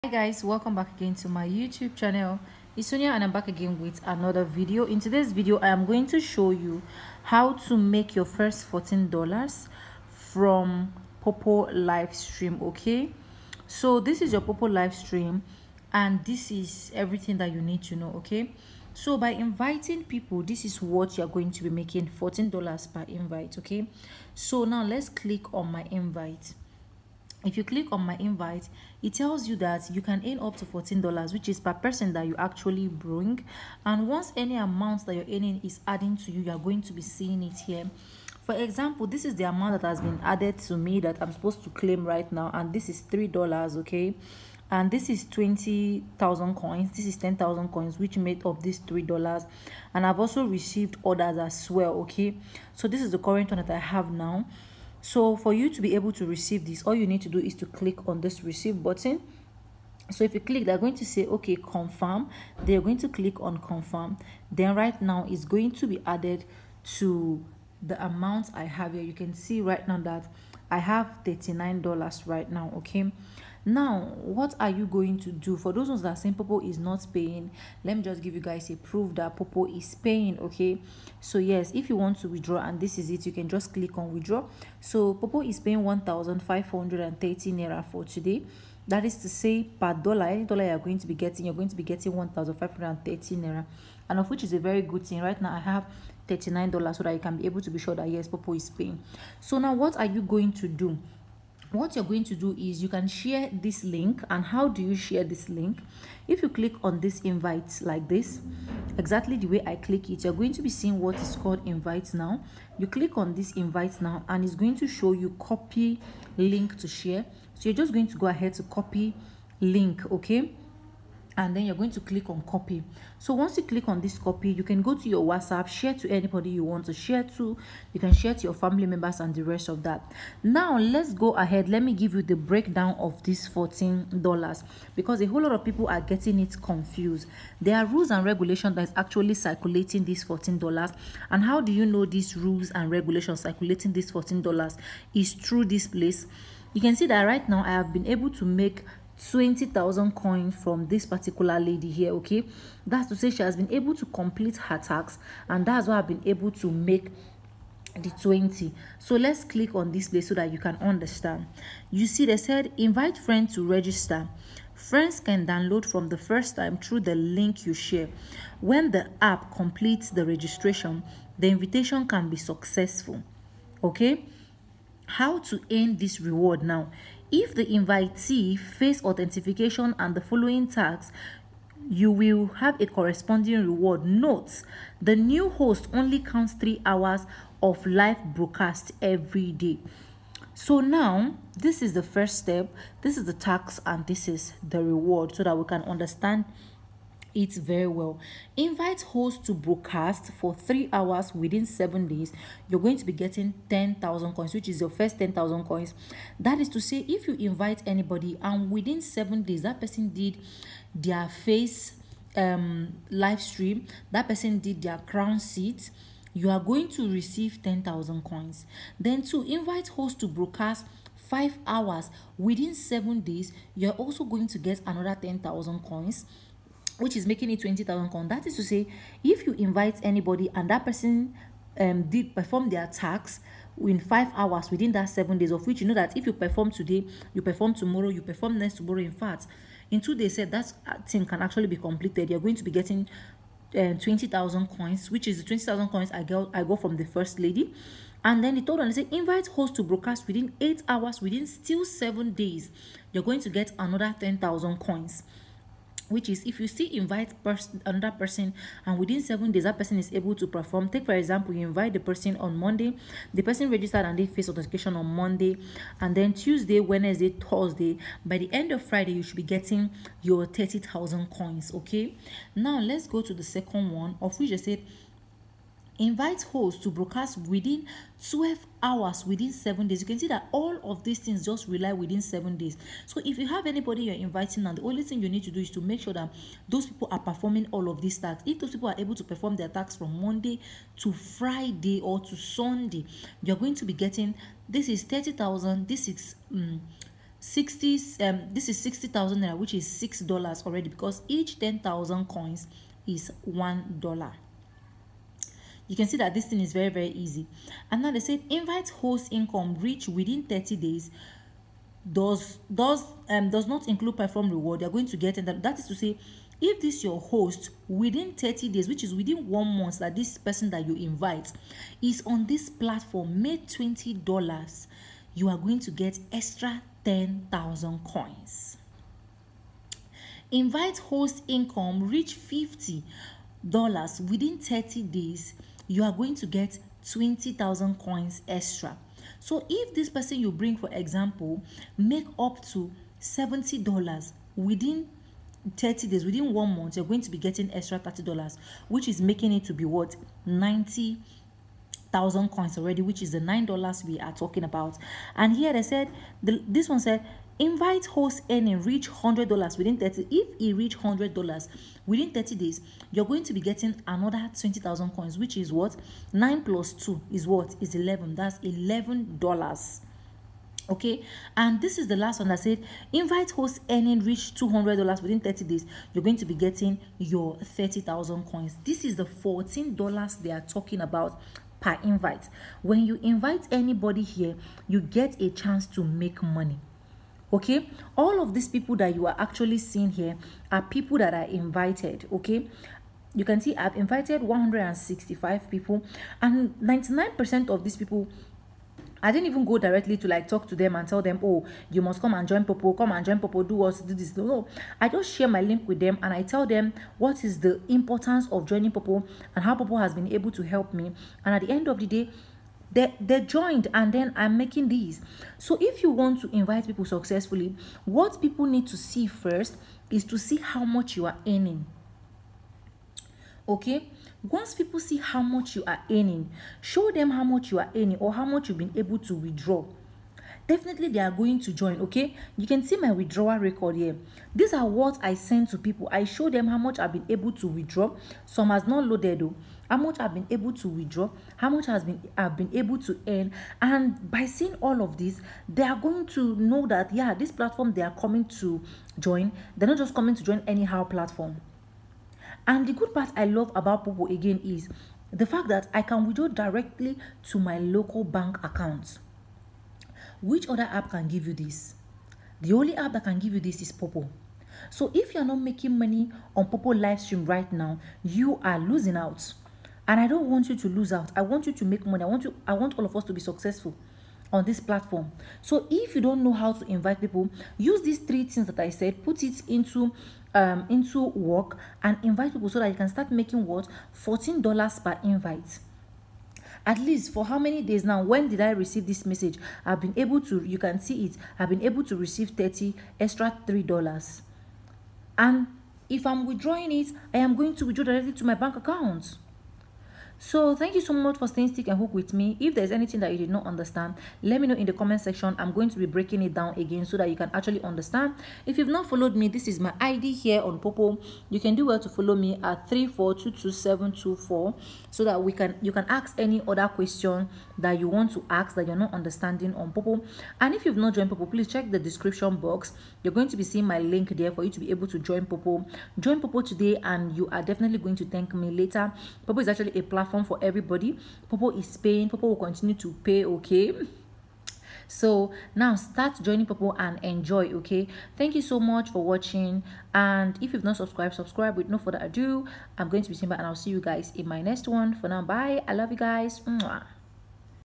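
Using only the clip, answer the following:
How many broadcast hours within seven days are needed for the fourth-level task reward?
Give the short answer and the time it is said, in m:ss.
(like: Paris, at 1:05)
12 hours, at 4:38.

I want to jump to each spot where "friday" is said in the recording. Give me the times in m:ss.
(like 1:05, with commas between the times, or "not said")
4:28, 4:51.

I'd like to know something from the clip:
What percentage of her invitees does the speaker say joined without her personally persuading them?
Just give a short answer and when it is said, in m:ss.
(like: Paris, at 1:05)
99 percent, at 6:36.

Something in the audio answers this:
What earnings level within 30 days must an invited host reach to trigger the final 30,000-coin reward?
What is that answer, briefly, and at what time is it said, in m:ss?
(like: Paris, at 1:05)
$200, at 6:14.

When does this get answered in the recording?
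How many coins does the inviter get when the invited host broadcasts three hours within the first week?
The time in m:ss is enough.
3:23.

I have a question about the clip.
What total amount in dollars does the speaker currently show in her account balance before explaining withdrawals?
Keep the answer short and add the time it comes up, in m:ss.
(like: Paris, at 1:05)
39 dollars, at 1:11.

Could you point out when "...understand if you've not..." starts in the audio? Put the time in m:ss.
8:27.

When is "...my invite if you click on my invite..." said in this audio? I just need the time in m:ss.
0:25.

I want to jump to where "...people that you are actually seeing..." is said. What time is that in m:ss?
6:28.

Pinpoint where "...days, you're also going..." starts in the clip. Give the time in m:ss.
3:43.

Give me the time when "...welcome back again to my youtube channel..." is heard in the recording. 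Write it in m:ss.
0:00.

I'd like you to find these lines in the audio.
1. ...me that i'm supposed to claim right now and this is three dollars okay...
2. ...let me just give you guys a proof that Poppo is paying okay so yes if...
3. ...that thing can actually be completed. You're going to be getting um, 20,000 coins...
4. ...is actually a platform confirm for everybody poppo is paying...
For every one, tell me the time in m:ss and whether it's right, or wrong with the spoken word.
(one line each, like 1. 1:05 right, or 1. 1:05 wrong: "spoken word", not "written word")
1. 0:40 right
2. 1:17 right
3. 4:00 right
4. 8:49 wrong: "platform", not "confirm".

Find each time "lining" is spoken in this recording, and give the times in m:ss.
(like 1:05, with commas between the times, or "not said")
not said.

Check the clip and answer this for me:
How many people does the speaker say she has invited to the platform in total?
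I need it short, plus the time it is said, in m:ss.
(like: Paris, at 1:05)
165, at 6:34.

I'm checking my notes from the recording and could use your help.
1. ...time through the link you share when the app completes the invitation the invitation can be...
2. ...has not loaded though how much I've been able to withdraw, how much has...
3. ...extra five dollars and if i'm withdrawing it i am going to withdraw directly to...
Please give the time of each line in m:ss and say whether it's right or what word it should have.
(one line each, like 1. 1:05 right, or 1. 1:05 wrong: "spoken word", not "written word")
1. 2:46 wrong: "registration", not "invitation"
2. 7:18 right
3. 8:13 wrong: "three", not "five".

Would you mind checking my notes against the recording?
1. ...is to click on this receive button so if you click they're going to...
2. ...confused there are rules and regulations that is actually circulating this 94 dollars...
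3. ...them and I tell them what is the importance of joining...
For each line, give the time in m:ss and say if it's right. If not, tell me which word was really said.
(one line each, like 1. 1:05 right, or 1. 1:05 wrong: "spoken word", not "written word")
1. 0:57 right
2. 2:16 wrong: "14", not "94"
3. 6:45 right.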